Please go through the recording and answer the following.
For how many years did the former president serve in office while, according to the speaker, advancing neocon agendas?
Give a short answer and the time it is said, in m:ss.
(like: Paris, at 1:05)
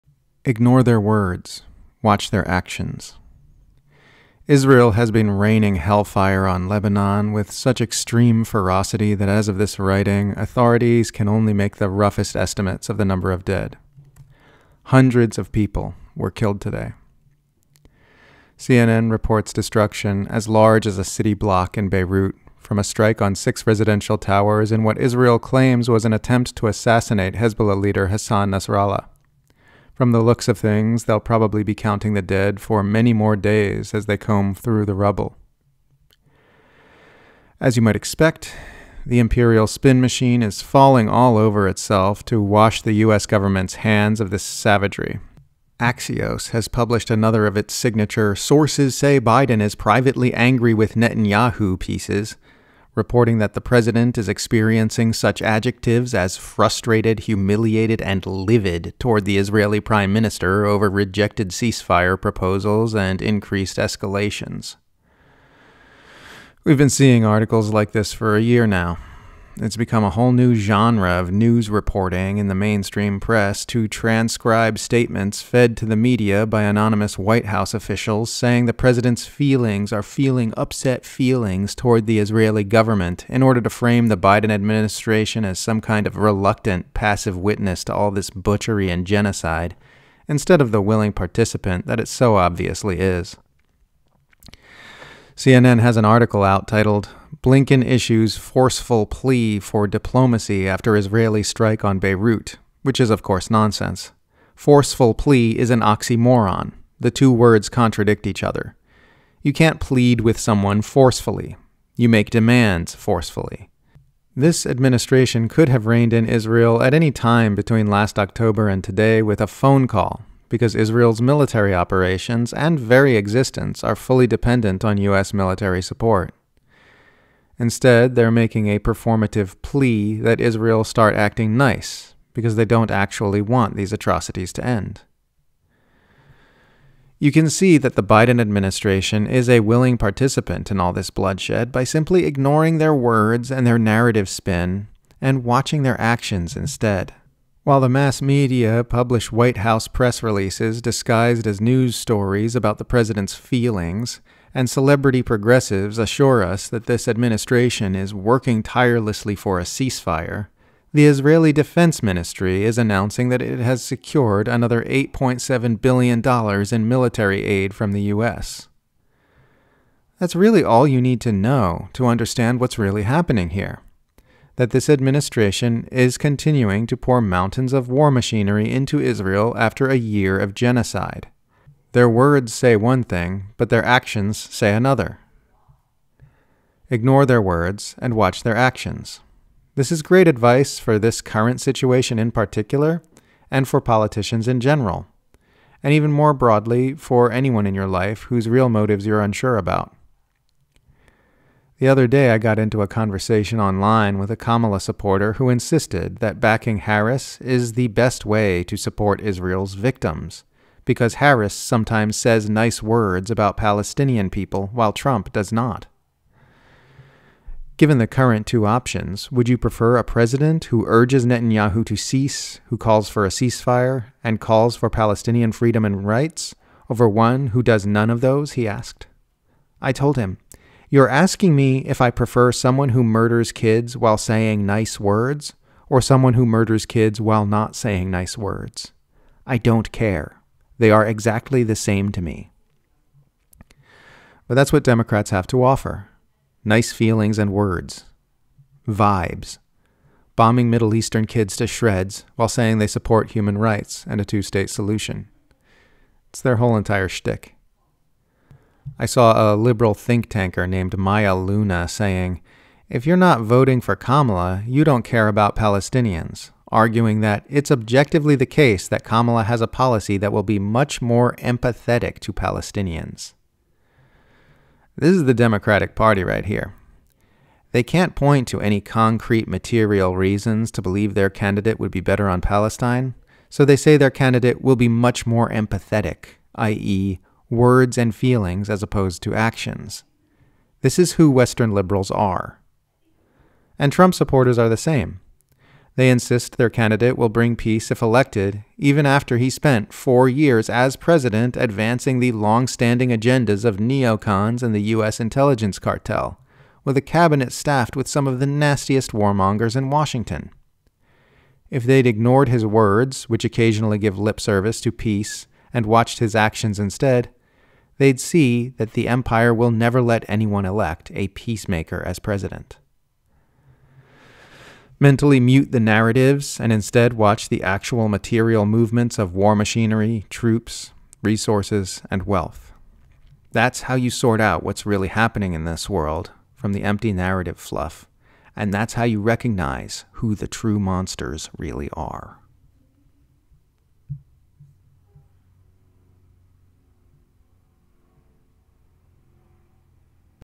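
4, at 4:59.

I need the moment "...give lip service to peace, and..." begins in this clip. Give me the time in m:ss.
5:13.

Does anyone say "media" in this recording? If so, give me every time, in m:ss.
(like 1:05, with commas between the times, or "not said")
1:15, 2:28.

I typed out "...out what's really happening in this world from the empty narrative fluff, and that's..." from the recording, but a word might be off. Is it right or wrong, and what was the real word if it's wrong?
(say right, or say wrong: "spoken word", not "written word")
right.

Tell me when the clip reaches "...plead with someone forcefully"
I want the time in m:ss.
1:49.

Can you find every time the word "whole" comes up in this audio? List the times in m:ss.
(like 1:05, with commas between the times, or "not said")
1:10, 4:16.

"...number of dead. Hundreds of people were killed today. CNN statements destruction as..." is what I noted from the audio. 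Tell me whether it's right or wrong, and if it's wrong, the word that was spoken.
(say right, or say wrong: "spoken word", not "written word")
wrong: "reports", not "statements".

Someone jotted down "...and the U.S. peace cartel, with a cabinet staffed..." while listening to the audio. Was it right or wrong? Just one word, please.
wrong.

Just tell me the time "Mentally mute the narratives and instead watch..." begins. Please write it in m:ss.
5:24.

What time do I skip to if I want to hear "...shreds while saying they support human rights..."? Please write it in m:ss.
4:11.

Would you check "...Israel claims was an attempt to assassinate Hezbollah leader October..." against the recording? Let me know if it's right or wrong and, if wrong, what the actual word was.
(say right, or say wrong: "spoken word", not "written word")
wrong: "Hassan", not "October".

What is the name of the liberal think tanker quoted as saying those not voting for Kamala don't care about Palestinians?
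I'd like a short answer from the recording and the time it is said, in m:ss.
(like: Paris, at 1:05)
Maya Luna, at 4:20.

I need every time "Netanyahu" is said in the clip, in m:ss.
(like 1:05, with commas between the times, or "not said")
0:50, 3:41.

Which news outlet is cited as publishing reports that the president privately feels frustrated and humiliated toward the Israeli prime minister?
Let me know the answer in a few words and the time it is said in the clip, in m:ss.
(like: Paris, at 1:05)
Axios, at 0:45.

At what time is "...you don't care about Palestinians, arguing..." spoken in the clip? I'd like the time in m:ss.
4:24.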